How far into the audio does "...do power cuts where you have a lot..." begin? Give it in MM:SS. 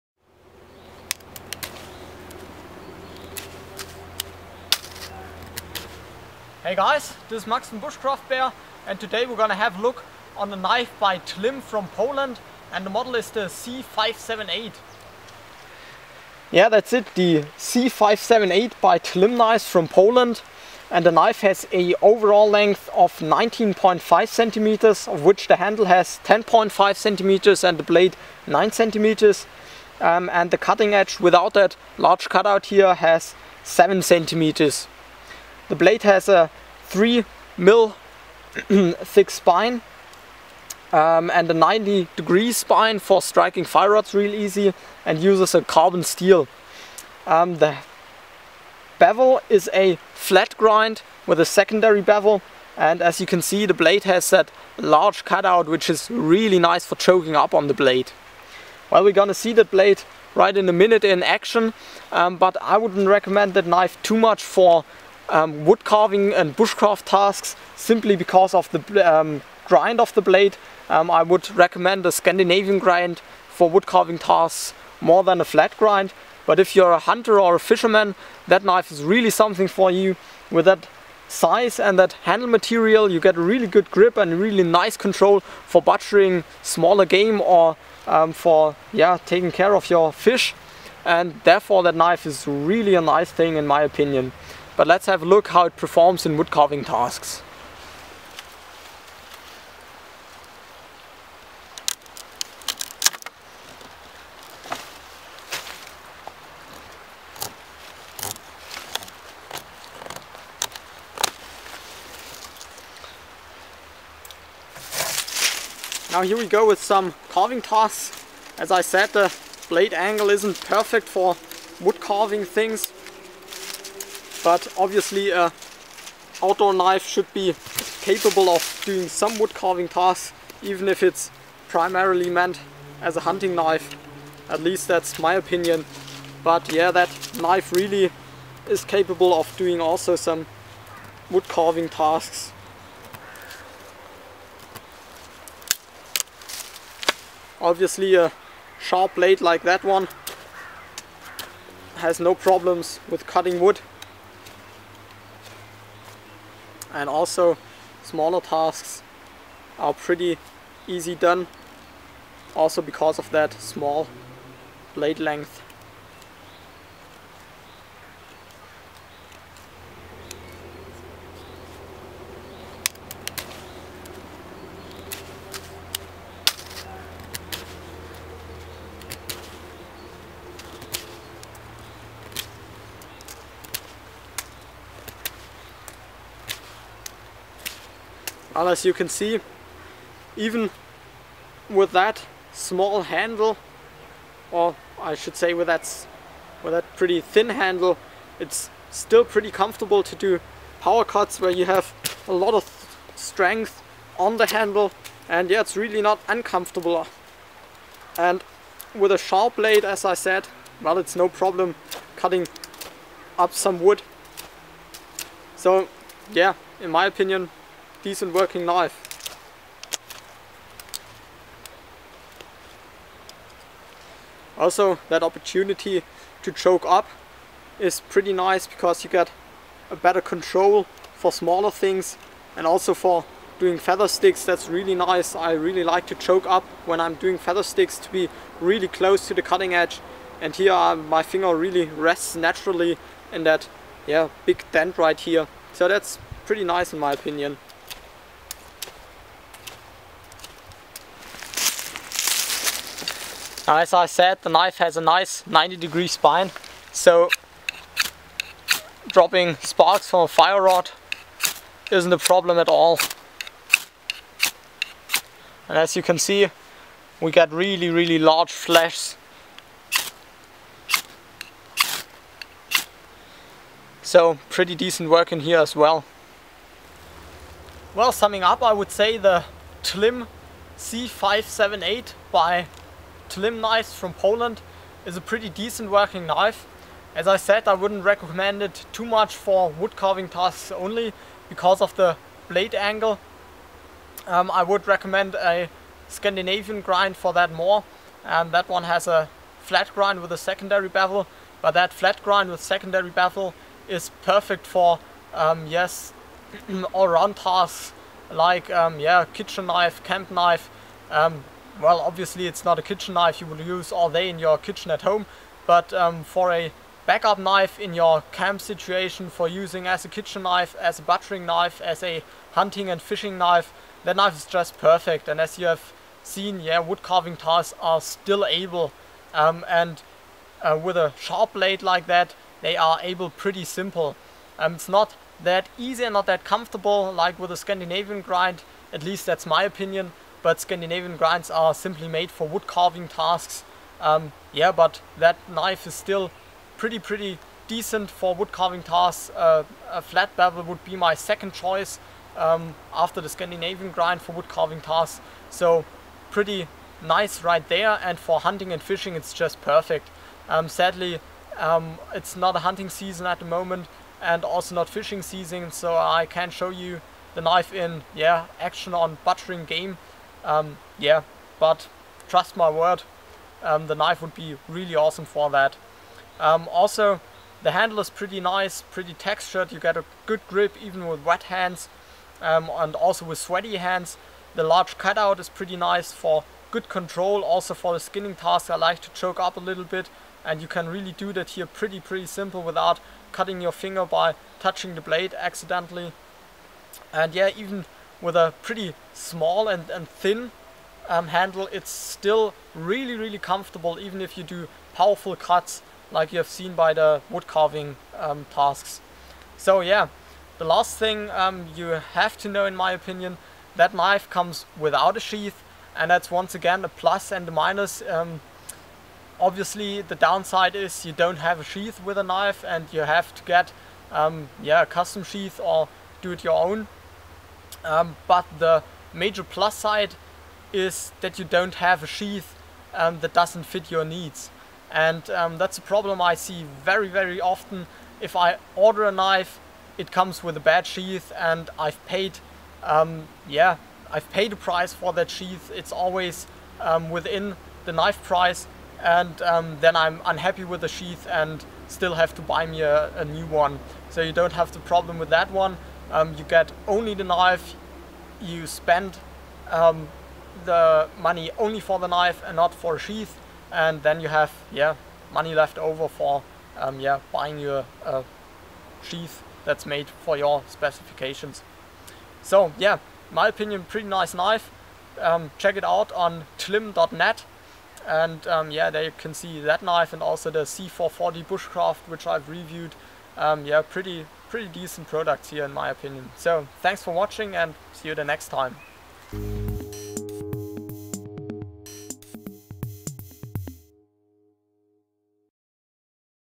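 03:20.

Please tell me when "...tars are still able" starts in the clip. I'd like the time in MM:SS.
05:27.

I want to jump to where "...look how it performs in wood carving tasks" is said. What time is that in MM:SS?
01:35.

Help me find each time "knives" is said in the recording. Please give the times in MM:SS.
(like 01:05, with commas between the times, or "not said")
04:43.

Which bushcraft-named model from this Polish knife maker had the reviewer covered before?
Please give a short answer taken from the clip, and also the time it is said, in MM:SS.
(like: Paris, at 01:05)
C440 Bushcraft, at 08:00.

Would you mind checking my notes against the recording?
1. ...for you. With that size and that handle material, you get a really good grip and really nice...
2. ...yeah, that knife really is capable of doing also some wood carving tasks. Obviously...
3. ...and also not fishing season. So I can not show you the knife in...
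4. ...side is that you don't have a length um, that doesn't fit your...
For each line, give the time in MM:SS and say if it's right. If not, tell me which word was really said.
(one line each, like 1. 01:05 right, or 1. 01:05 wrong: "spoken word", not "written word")
1. 01:19 right
2. 02:16 right
3. 06:04 right
4. 07:09 wrong: "sheath", not "length".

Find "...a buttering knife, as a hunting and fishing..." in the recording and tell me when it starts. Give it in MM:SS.
05:20.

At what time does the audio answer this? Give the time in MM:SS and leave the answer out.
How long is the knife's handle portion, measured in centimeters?
00:26.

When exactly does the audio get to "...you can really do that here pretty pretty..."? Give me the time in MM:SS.
06:30.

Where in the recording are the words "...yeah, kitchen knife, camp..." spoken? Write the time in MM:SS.
05:08.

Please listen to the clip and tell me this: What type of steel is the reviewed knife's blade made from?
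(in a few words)
Carbon steel.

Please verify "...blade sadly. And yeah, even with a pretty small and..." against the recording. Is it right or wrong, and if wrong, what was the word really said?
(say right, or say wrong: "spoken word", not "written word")
wrong: "accidentally", not "sadly".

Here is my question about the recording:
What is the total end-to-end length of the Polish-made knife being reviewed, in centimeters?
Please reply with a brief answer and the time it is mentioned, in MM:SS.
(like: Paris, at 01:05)
19.5 centimeters, at 00:23.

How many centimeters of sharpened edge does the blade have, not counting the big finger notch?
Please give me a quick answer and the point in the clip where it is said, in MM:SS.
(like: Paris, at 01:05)
7 centimeters, at 00:33.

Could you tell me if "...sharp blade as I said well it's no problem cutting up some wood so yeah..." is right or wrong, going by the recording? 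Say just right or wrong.
right.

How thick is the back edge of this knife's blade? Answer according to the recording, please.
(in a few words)
3 mm.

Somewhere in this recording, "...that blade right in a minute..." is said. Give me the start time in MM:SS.
00:59.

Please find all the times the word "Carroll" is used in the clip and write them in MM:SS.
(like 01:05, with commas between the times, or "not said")
not said.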